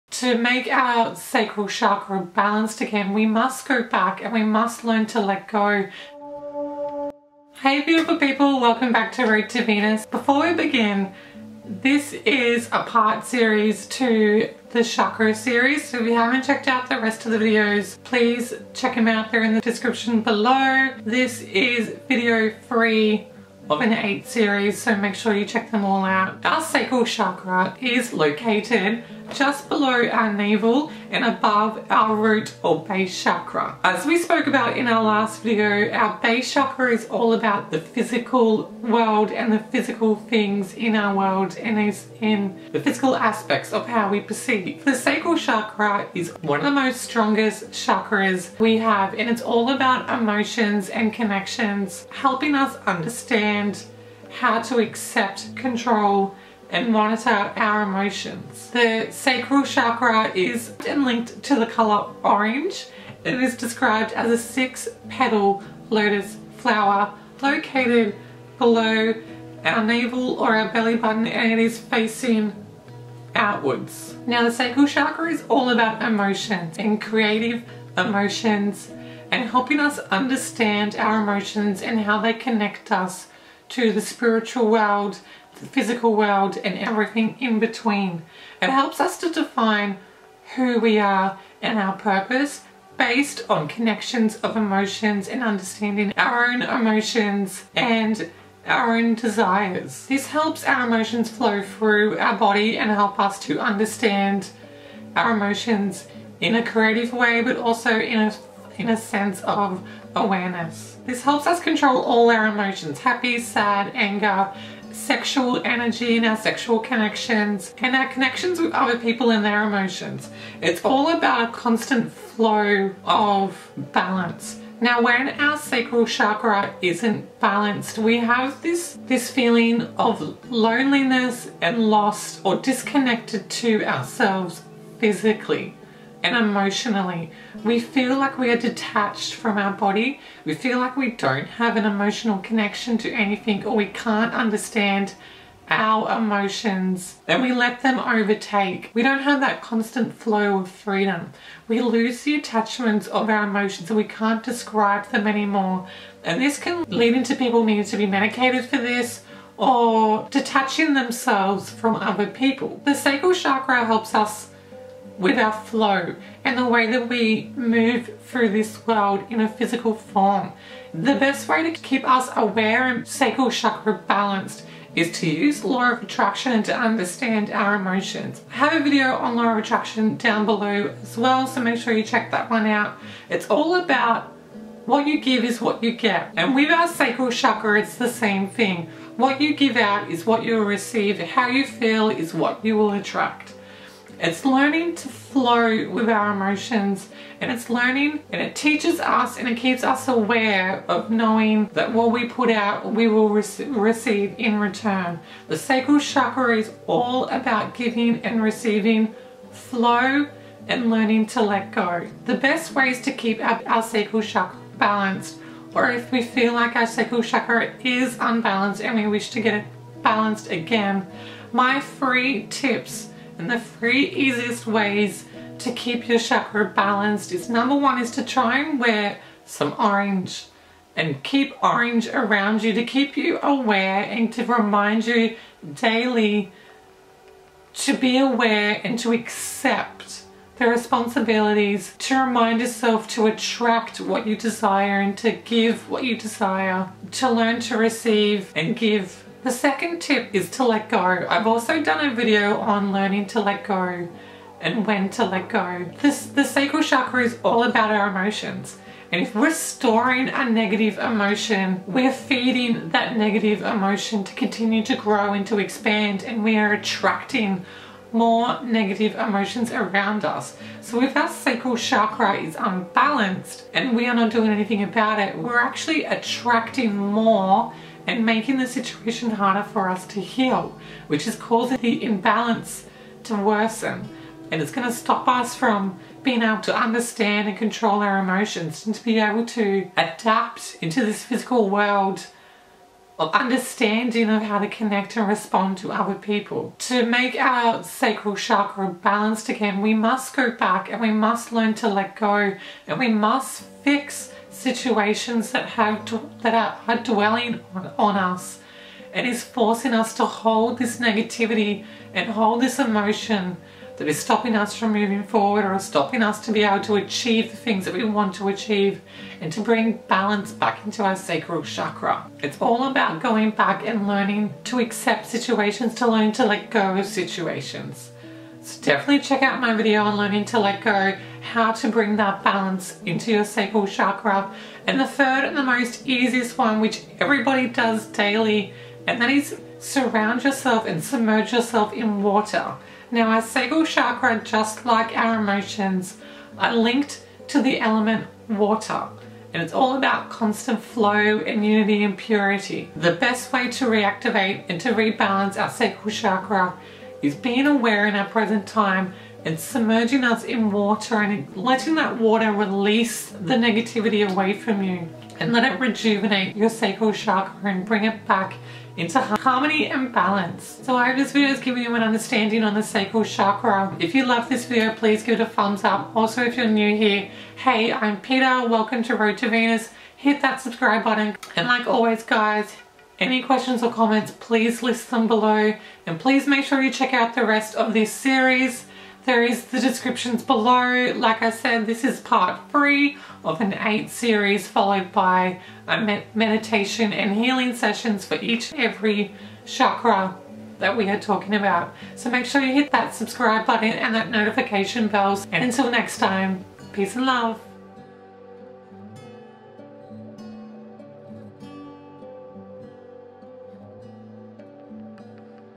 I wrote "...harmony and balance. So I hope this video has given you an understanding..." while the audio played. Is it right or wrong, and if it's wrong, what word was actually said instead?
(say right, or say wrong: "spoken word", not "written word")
right.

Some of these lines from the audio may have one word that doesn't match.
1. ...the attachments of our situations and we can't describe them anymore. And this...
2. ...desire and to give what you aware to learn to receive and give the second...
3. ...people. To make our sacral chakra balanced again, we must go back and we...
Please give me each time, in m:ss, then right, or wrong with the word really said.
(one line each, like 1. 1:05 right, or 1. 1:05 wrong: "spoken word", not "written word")
1. 2:32 wrong: "emotions", not "situations"
2. 4:04 wrong: "desire", not "aware"
3. 4:56 right.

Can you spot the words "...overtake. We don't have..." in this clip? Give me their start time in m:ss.
2:27.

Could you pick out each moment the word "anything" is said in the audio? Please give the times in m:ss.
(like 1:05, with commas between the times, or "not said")
2:23, 4:34.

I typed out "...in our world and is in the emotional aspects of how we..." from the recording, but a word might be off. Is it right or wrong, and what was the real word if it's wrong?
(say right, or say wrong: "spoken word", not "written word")
wrong: "physical", not "emotional".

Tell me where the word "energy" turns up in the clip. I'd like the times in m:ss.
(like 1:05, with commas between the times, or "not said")
1:55.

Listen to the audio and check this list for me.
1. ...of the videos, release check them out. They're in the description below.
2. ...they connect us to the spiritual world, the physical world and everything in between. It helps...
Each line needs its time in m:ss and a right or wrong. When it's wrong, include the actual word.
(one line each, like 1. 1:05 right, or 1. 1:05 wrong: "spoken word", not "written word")
1. 0:17 wrong: "please", not "release"
2. 1:22 right.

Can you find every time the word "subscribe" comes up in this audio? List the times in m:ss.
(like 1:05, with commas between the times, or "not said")
6:20, 6:43.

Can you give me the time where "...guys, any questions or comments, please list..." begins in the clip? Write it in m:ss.
6:22.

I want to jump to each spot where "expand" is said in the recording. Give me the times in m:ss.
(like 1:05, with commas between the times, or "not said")
4:25.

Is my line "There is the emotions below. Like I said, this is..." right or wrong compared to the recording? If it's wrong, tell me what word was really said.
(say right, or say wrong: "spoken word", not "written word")
wrong: "descriptions", not "emotions".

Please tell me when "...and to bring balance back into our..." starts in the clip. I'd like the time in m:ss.
5:19.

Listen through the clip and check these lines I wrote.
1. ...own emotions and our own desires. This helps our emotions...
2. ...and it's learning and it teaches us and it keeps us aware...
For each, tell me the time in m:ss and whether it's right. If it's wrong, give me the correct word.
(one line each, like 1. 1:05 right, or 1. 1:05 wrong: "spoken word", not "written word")
1. 1:36 right
2. 3:17 right.